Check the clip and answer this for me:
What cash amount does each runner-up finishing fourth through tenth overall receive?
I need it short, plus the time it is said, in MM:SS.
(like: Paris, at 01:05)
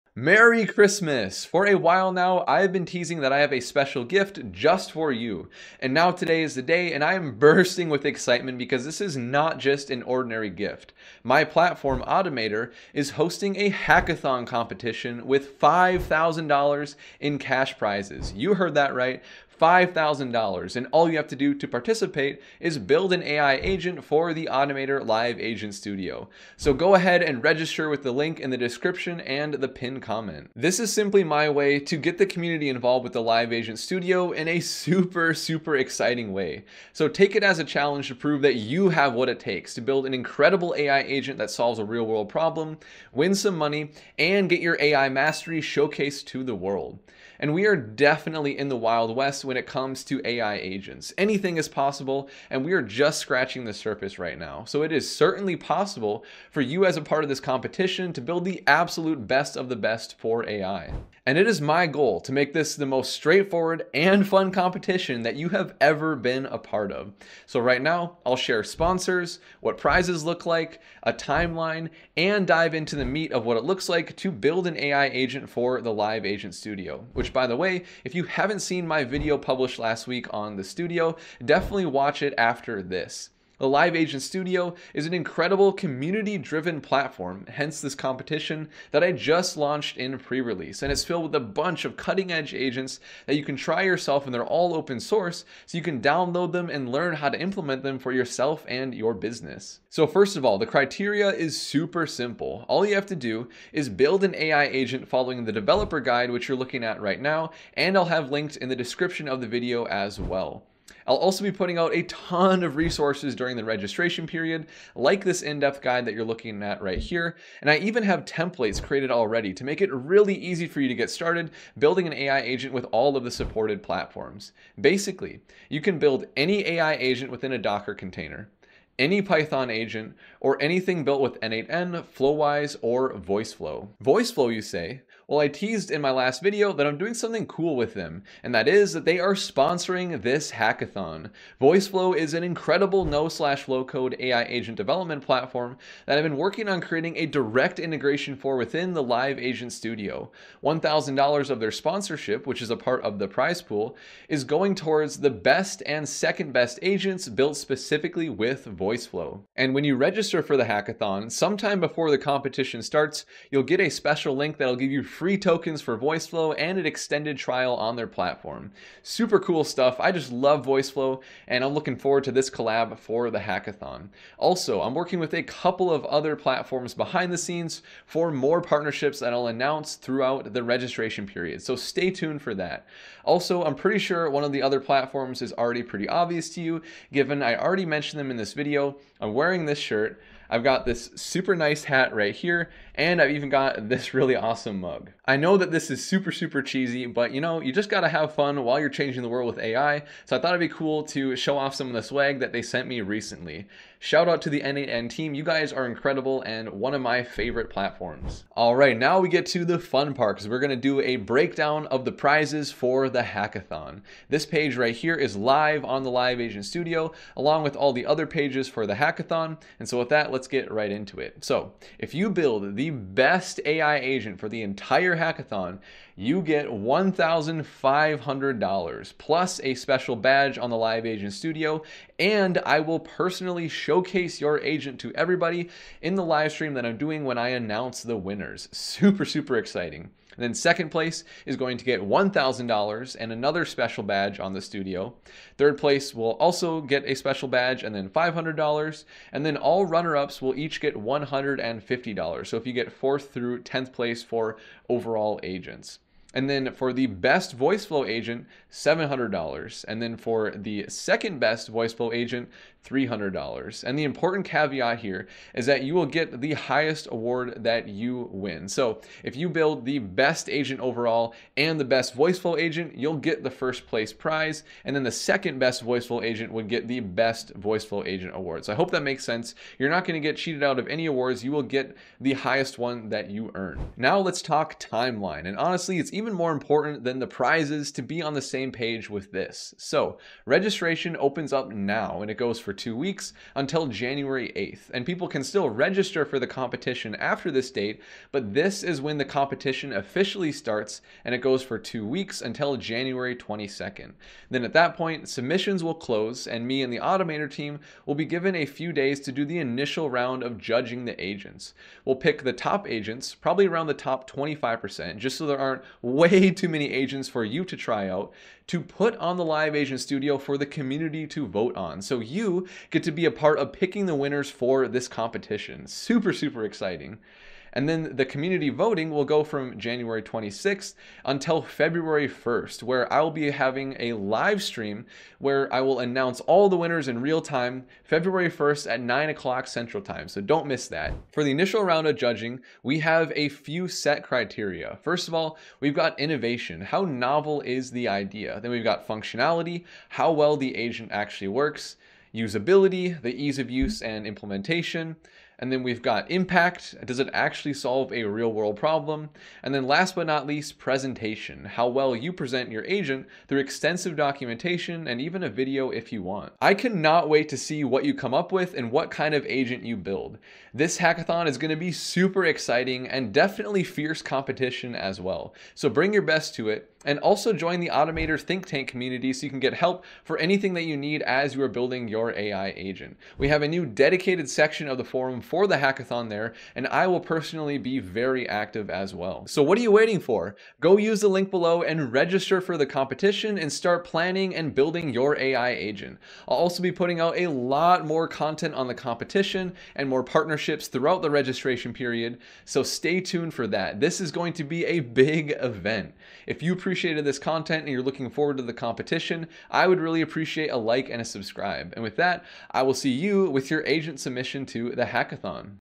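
$150, at 04:10.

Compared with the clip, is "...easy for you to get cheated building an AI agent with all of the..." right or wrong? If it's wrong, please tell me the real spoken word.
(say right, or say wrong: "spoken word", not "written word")
wrong: "started", not "cheated".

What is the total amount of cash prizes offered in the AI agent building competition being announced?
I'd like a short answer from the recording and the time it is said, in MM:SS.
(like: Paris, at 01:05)
$5,000, at 00:15.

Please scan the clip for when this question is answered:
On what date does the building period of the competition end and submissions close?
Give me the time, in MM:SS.
05:02.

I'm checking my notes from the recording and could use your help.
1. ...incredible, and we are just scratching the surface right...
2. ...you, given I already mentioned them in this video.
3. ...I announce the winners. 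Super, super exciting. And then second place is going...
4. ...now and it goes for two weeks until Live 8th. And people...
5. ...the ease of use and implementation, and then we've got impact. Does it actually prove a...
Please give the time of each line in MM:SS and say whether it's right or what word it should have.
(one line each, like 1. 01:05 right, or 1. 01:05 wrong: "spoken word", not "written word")
1. 00:51 wrong: "possible", not "incredible"
2. 03:06 right
3. 03:57 right
4. 04:51 wrong: "January", not "Live"
5. 05:53 wrong: "solve", not "prove".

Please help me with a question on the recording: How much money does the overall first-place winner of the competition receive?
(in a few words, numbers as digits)
$1,500.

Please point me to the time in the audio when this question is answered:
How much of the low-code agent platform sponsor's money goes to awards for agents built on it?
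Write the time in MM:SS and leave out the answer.
02:30.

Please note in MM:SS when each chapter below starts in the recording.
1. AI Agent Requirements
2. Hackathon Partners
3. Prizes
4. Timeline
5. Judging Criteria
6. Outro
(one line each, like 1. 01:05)
1. 01:39
2. 02:13
3. 03:28
4. 04:43
5. 05:41
6. 06:06.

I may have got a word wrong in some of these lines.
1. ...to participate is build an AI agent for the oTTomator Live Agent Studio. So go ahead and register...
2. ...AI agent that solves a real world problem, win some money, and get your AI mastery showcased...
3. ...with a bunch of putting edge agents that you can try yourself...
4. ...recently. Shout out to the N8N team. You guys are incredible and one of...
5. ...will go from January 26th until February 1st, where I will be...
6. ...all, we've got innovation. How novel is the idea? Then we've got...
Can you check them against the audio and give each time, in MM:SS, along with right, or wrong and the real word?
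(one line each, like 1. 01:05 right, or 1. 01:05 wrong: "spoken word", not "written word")
1. 00:21 right
2. 00:40 right
3. 01:31 wrong: "cutting", not "putting"
4. 03:22 right
5. 05:29 right
6. 05:45 right.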